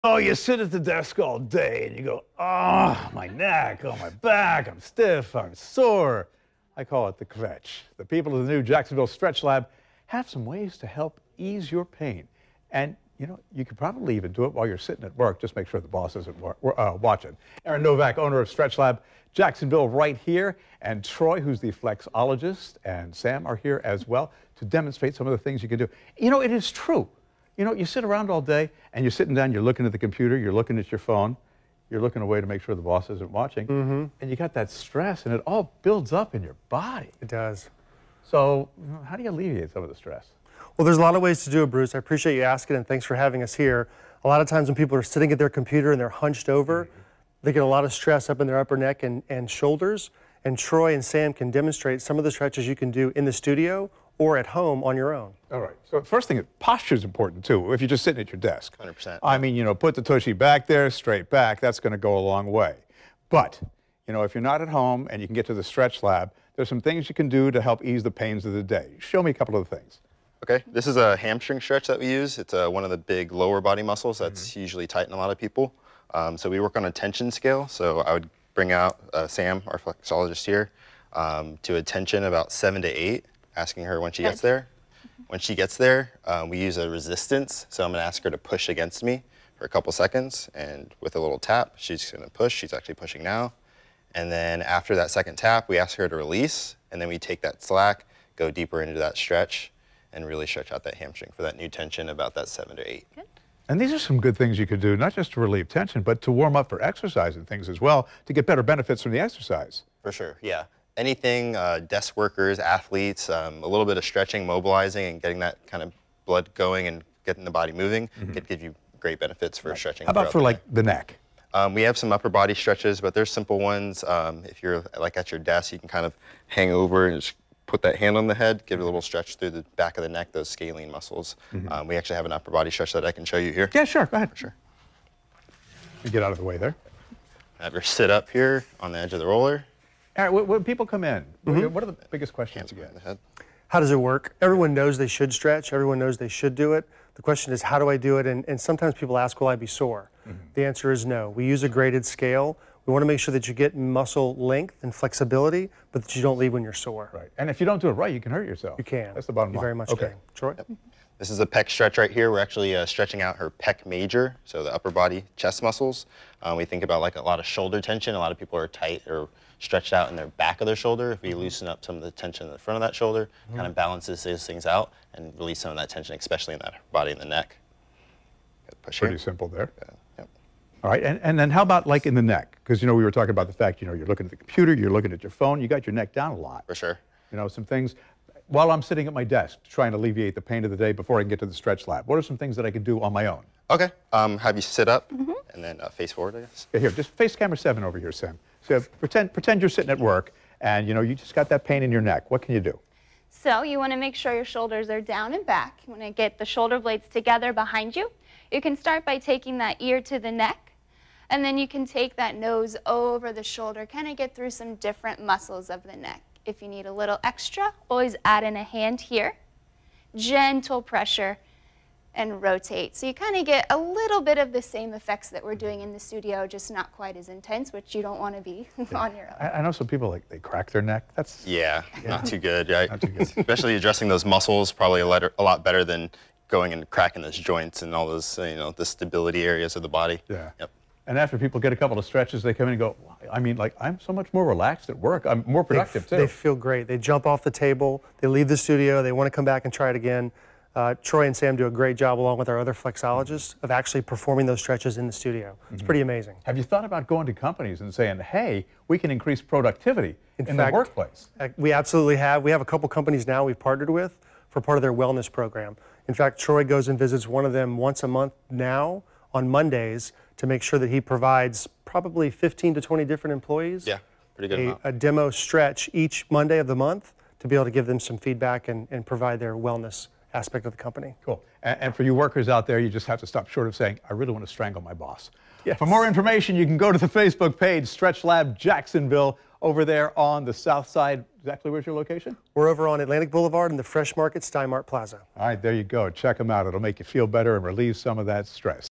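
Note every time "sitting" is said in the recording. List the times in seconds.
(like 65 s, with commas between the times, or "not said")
14 s, 29 s, 45 s, 58 s, 188 s, 199 s.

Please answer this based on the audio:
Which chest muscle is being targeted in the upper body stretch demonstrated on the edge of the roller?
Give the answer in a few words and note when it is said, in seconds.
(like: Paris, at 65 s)
Pec major, at 163 s.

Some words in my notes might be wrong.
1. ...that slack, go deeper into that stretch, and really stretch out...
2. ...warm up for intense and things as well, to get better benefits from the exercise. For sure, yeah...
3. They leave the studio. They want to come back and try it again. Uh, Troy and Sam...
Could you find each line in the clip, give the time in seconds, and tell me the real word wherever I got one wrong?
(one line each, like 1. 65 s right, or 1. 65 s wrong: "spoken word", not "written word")
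1. 97 s right
2. 106 s wrong: "exercise", not "intense"
3. 248 s right.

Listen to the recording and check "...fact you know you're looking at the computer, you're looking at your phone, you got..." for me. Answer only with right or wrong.
right.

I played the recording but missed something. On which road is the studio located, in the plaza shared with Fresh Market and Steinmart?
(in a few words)
Atlantic Boulevard.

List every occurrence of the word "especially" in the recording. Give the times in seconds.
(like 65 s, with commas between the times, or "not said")
176 s, 233 s.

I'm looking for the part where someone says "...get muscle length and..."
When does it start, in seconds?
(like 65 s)
153 s.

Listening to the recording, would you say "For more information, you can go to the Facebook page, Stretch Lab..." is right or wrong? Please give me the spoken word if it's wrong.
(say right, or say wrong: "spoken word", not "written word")
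right.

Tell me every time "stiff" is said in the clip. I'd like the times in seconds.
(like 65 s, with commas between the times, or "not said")
4 s.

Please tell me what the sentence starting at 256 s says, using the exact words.
Have you thought about going to companies and saying, hey, we can increase productivity in, in fact, the workplace?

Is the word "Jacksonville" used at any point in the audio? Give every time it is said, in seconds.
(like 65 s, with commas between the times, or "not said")
8 s, 19 s, 288 s.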